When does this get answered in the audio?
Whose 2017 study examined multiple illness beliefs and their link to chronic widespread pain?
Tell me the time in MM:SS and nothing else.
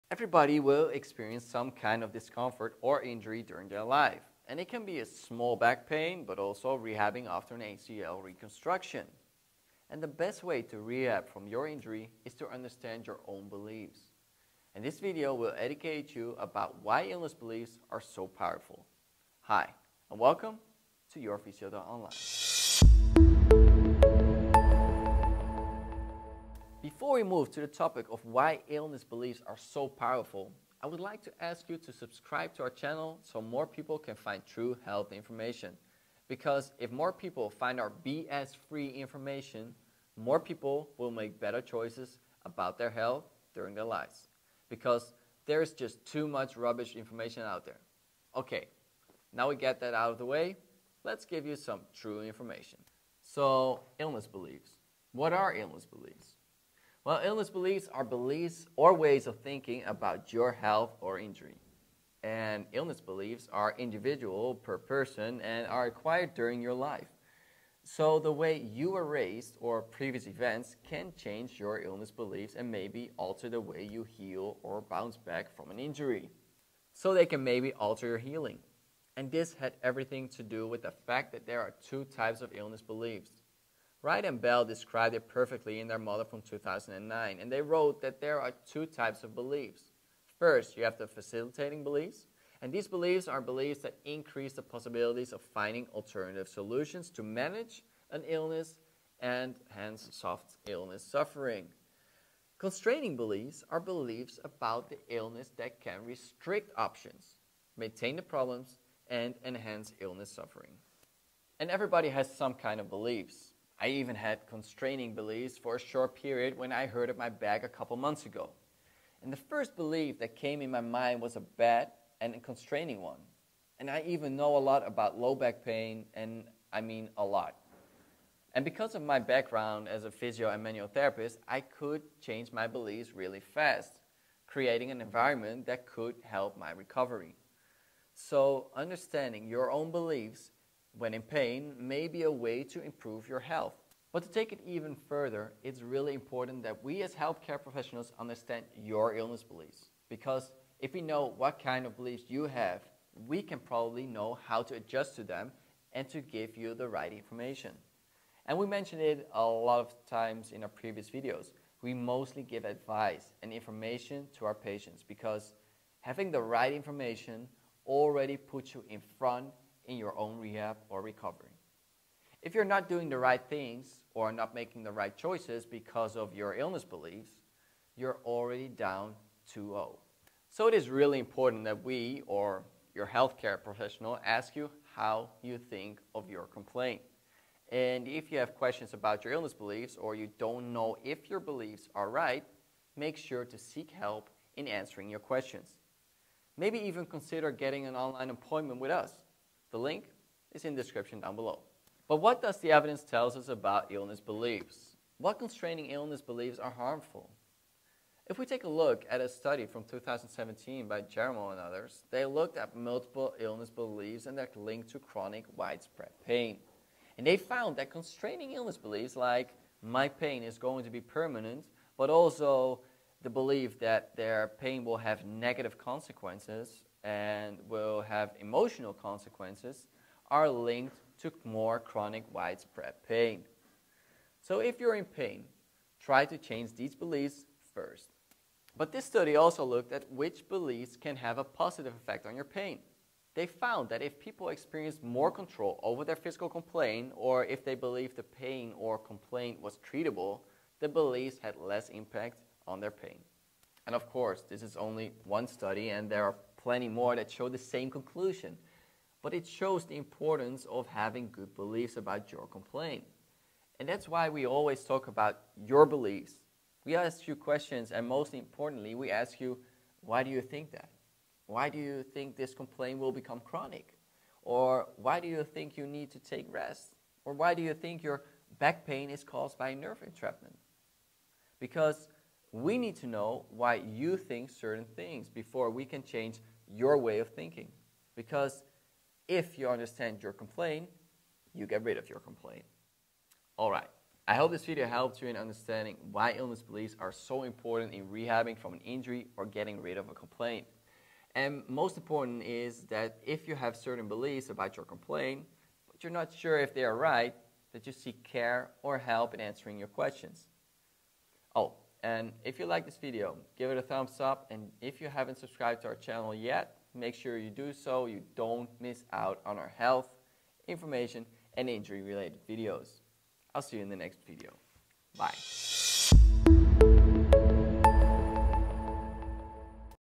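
03:31.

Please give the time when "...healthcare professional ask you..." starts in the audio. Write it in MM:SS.
03:03.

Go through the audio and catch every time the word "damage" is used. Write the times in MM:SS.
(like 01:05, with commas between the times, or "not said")
not said.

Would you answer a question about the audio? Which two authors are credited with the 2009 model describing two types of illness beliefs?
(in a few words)
Wright and Bell.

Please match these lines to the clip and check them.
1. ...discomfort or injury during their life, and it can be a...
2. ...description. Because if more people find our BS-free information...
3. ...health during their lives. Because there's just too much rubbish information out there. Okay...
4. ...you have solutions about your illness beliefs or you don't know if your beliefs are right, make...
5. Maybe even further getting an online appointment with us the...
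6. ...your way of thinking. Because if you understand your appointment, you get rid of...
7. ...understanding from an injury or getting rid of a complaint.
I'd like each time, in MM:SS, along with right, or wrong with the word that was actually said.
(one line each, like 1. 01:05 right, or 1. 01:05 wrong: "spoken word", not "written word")
1. 00:02 right
2. 00:35 wrong: "information", not "description"
3. 00:42 right
4. 03:08 wrong: "questions", not "solutions"
5. 03:16 wrong: "consider", not "further"
6. 04:46 wrong: "complaint", not "appointment"
7. 04:58 wrong: "rehabbing", not "understanding".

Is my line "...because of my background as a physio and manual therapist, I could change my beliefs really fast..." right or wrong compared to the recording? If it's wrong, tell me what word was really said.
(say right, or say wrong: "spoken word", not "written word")
right.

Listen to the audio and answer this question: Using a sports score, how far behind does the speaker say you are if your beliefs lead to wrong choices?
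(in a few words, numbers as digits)
2-0.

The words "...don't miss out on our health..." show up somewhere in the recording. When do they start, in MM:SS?
05:18.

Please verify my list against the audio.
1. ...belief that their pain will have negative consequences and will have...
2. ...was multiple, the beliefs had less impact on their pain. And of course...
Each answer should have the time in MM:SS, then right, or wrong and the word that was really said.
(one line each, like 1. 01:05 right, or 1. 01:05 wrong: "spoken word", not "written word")
1. 03:43 right
2. 04:09 wrong: "treatable", not "multiple".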